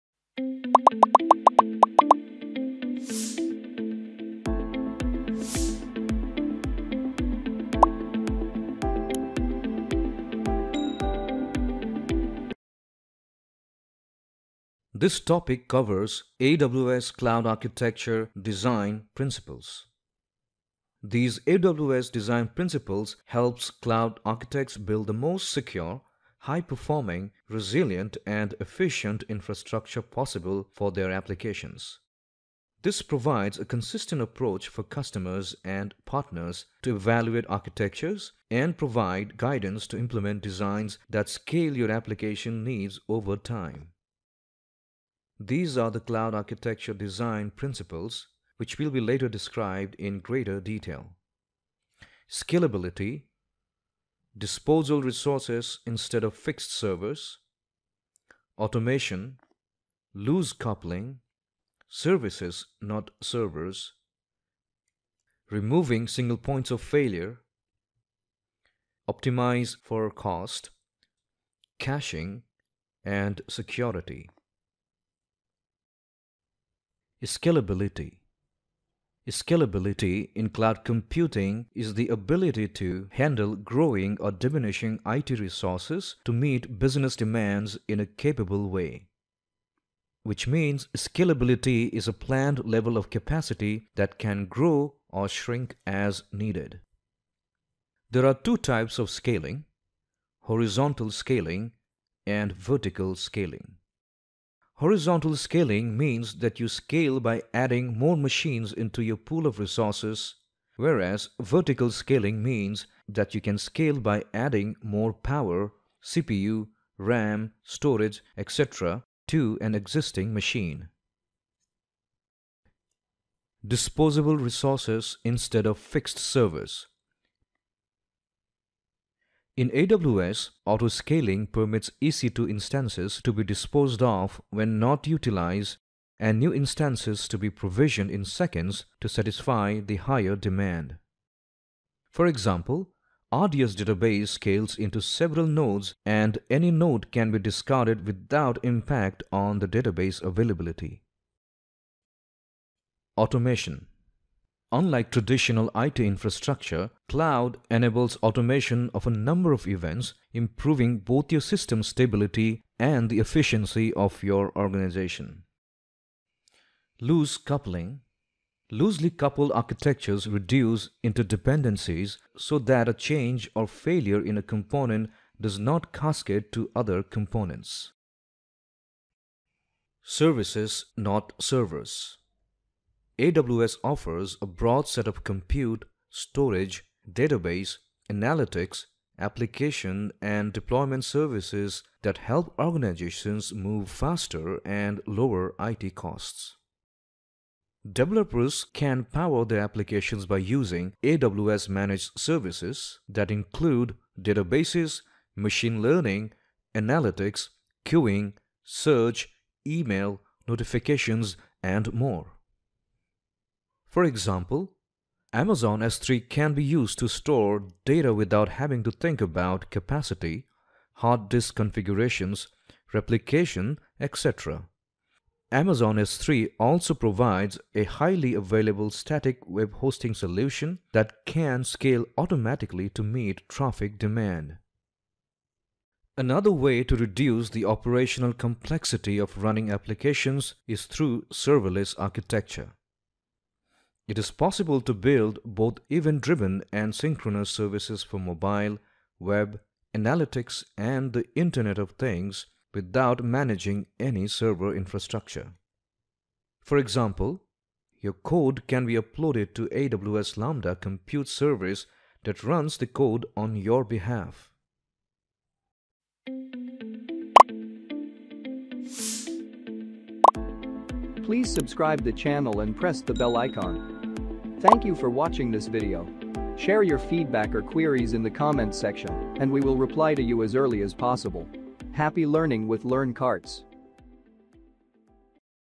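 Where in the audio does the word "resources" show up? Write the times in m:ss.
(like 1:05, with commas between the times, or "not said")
0:55, 1:25, 1:49, 2:04.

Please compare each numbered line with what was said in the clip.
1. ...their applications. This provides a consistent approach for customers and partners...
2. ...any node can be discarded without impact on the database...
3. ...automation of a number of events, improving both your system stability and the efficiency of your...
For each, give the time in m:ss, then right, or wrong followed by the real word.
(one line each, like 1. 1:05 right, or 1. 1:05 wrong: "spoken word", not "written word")
1. 0:30 right
2. 2:26 right
3. 2:38 right.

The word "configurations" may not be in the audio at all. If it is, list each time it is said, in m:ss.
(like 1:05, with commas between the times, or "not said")
3:41.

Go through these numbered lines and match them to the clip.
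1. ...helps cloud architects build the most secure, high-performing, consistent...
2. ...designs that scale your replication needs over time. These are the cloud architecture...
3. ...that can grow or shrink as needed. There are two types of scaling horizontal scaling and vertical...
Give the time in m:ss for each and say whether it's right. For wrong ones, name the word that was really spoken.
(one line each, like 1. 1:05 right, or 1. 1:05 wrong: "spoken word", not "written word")
1. 0:23 wrong: "resilient", not "consistent"
2. 0:40 wrong: "application", not "replication"
3. 1:33 right.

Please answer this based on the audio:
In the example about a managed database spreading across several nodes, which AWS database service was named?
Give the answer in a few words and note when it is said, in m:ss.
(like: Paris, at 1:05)
RDS, at 2:23.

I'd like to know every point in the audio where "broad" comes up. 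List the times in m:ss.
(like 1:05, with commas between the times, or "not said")
3:04.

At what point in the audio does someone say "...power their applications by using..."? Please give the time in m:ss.
3:19.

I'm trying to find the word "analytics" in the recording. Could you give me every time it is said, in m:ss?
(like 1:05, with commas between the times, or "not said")
3:08, 3:26, 4:09.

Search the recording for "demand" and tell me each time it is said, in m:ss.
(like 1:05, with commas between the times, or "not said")
1:27, 2:20, 3:53.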